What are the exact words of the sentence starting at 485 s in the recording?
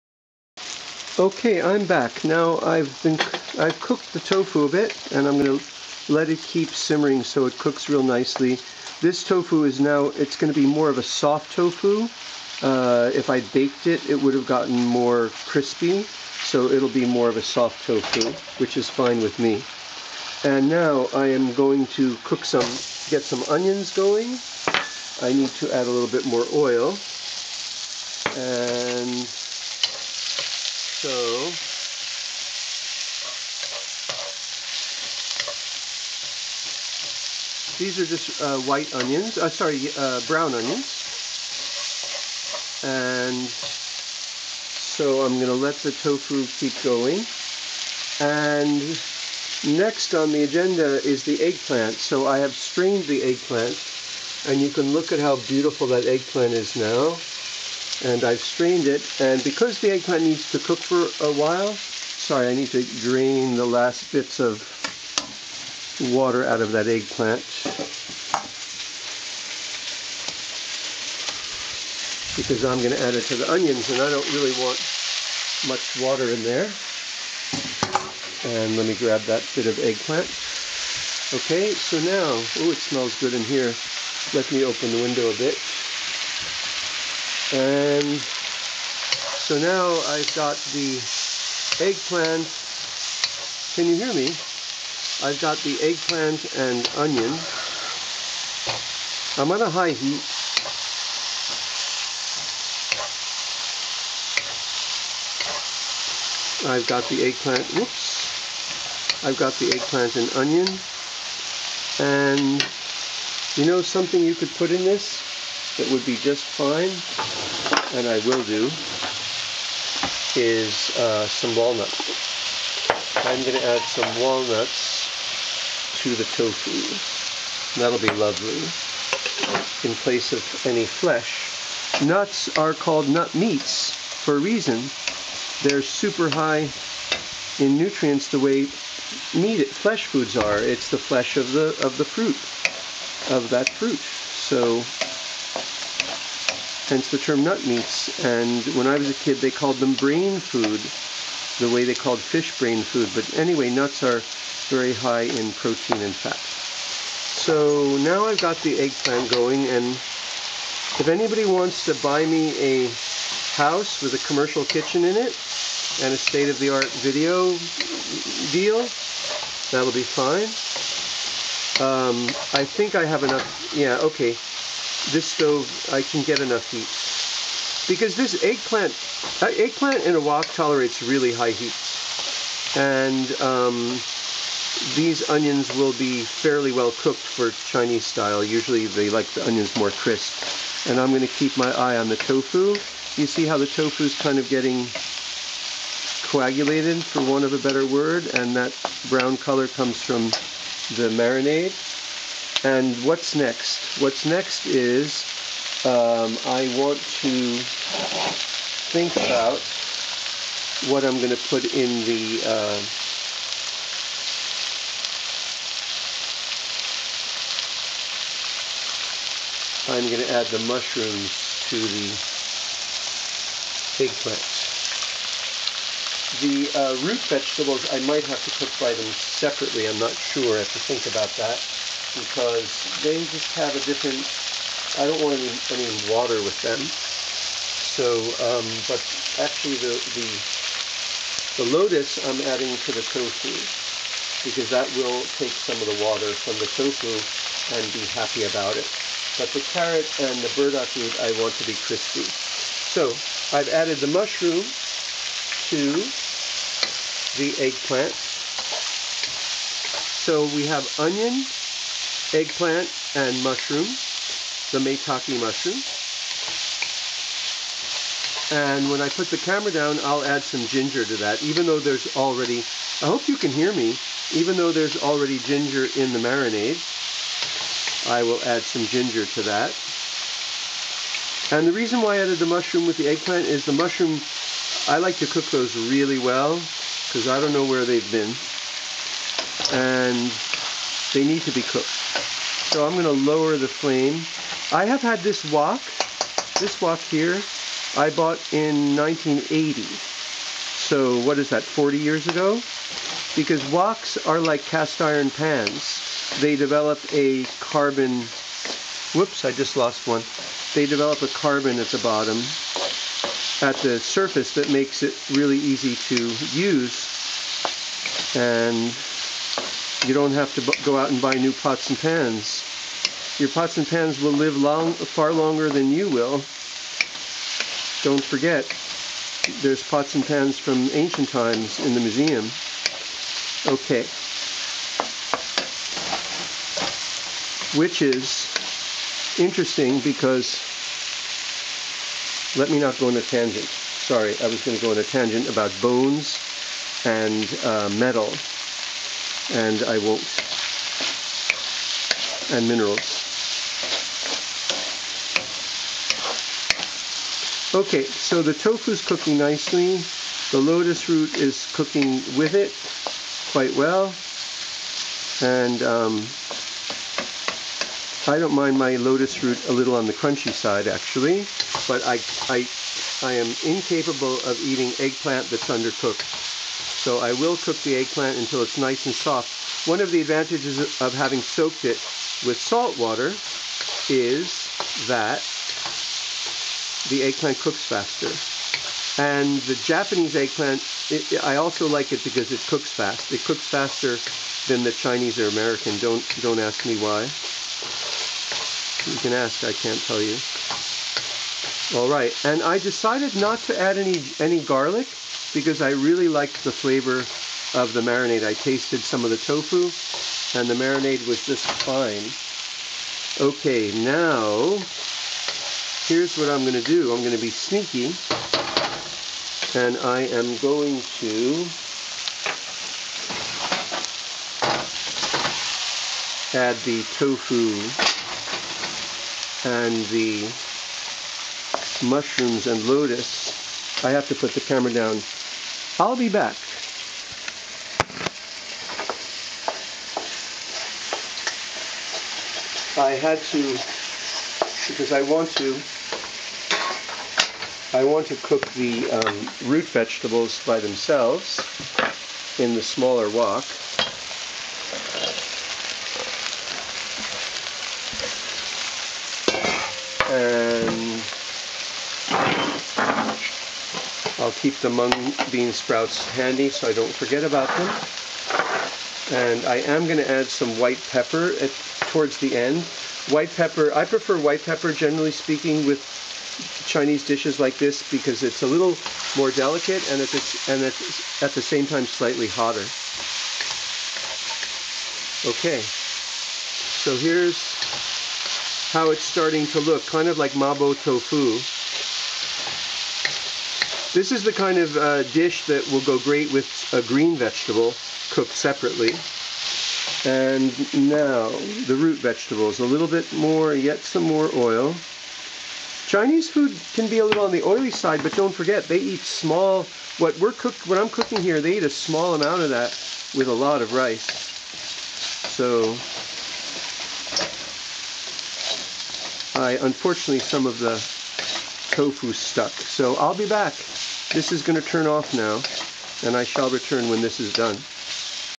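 Okay, so here's how it's starting to look, kind of like mabo tofu.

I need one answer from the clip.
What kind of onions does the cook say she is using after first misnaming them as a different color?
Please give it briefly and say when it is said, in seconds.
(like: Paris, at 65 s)
brown onions, at 40 s.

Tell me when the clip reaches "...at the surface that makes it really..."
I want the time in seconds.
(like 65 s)
313 s.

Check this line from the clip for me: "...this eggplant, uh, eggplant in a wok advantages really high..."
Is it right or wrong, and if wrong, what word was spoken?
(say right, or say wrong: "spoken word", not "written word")
wrong: "tolerates", not "advantages".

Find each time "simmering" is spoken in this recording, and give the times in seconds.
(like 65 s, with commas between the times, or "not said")
6 s.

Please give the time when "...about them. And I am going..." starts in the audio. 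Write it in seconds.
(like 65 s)
467 s.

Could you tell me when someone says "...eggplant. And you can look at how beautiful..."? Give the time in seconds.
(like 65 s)
53 s.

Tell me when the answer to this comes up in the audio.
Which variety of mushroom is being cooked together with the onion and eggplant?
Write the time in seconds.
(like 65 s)
264 s.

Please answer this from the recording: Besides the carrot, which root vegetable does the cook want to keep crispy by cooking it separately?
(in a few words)
burdock root.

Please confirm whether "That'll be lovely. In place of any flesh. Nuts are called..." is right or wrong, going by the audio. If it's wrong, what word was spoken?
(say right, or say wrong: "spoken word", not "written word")
right.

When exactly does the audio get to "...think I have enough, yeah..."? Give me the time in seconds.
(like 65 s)
172 s.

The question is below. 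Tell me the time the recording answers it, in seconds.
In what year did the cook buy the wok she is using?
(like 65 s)
298 s.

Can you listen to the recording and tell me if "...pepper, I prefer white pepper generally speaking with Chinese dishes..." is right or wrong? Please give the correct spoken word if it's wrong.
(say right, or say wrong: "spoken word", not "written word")
right.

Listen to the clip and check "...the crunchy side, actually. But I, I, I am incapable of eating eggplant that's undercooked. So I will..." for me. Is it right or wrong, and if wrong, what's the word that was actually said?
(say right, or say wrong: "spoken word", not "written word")
right.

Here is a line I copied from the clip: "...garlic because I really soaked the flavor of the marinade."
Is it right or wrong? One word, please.
wrong.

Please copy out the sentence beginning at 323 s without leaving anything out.
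Your pots and pans will live long, far longer than you will.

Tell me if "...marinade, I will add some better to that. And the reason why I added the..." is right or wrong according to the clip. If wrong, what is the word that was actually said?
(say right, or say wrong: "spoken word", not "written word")
wrong: "ginger", not "better".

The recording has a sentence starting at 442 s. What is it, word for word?
I had to, because I want to, I want to cook the um, root vegetables by themselves in the smaller wok.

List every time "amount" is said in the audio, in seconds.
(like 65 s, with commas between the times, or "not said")
512 s.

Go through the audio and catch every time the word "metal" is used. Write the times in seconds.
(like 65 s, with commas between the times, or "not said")
347 s.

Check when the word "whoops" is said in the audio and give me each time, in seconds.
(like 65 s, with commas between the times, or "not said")
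107 s, 309 s.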